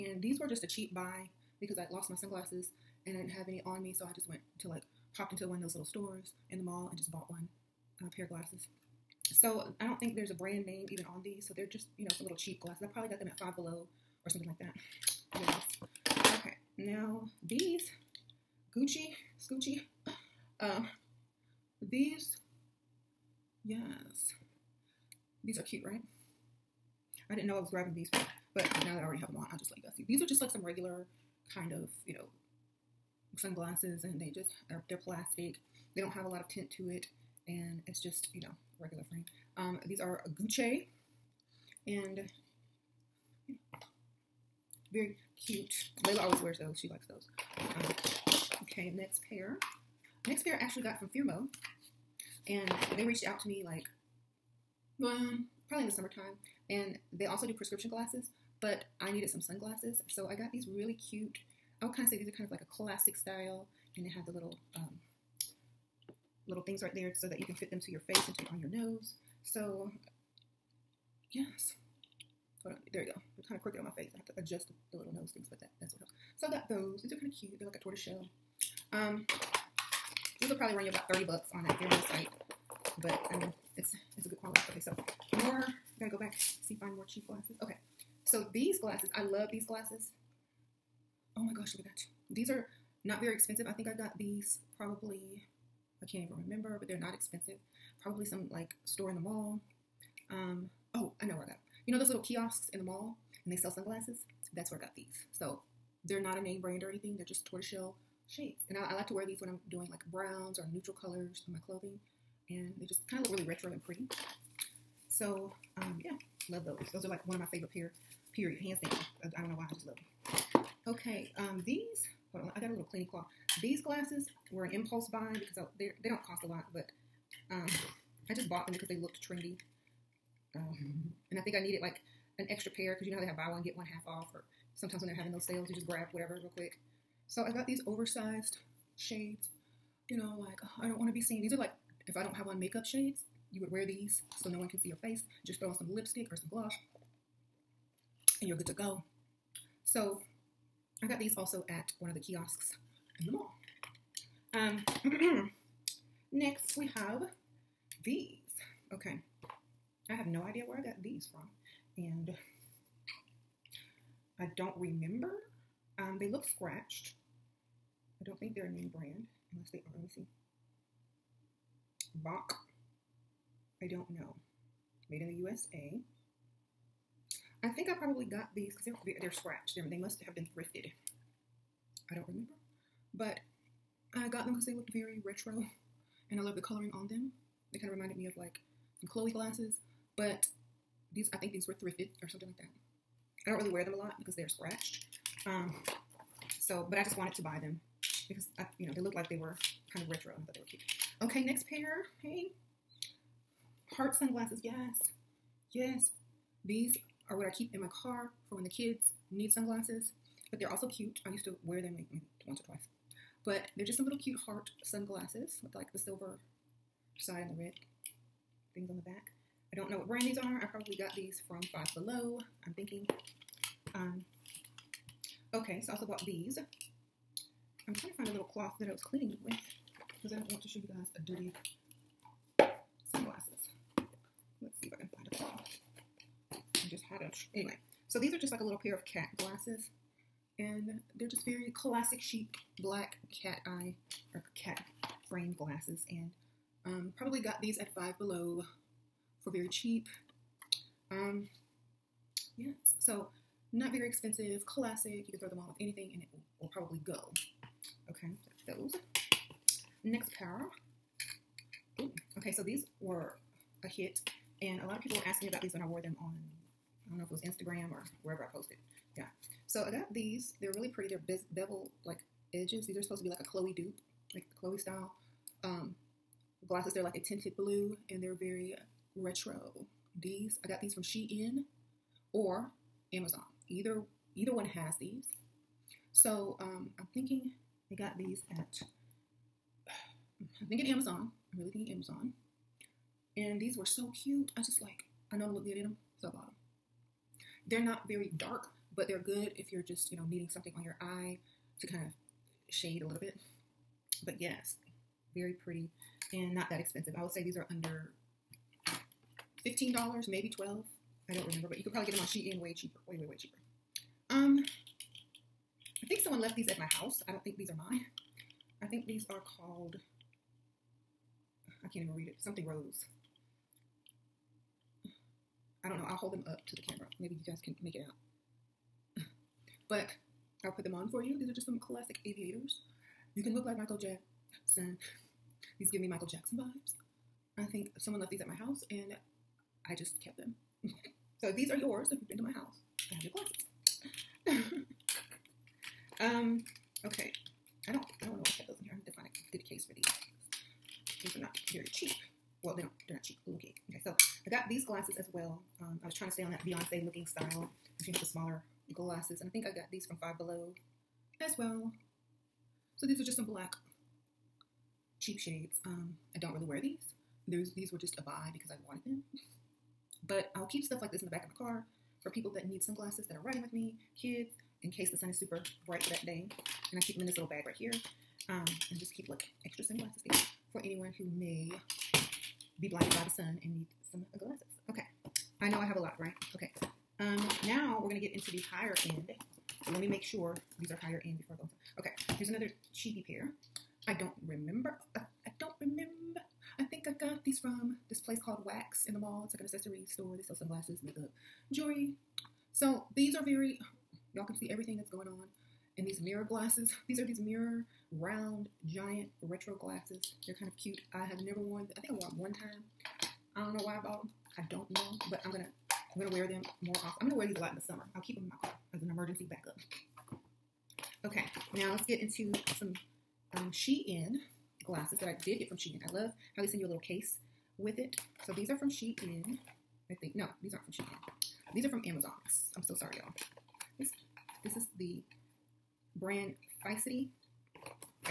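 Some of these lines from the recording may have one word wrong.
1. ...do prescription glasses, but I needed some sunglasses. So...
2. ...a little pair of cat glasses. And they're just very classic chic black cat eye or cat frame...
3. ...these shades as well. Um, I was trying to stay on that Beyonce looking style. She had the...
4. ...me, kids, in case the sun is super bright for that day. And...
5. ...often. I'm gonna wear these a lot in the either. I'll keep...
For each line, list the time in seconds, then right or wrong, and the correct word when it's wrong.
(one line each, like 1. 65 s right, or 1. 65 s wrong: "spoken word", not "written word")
1. 57 s right
2. 238 s right
3. 354 s wrong: "glasses", not "shades"
4. 373 s right
5. 416 s wrong: "summer", not "either".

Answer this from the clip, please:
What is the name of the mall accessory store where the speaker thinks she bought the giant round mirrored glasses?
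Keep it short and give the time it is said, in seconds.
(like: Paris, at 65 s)
Wax, at 398 s.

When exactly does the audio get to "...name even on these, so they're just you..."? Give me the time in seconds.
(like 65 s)
10 s.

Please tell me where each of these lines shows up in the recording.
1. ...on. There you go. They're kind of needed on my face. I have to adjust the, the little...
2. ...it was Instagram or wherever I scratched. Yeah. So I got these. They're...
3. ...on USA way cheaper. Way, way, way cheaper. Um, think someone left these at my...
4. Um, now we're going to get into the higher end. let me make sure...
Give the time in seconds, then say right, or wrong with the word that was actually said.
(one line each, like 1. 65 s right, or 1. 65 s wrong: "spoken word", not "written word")
1. 72 s wrong: "crooked", not "needed"
2. 267 s wrong: "posted", not "scratched"
3. 312 s wrong: "Shein", not "USA"
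4. 387 s right.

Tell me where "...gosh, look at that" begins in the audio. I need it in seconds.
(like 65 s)
91 s.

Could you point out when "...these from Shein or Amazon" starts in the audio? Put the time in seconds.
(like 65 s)
280 s.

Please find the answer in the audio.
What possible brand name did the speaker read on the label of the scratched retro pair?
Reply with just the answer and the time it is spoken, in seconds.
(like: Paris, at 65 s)
Bach, at 172 s.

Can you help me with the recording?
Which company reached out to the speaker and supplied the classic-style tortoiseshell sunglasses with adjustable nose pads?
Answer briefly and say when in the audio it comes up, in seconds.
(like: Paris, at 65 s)
Firmoo, at 51 s.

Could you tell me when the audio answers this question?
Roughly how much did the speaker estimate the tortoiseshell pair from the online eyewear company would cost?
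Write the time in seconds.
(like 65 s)
81 s.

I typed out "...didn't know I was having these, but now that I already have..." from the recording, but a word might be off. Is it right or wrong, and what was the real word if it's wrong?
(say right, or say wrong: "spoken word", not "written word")
wrong: "grabbing", not "having".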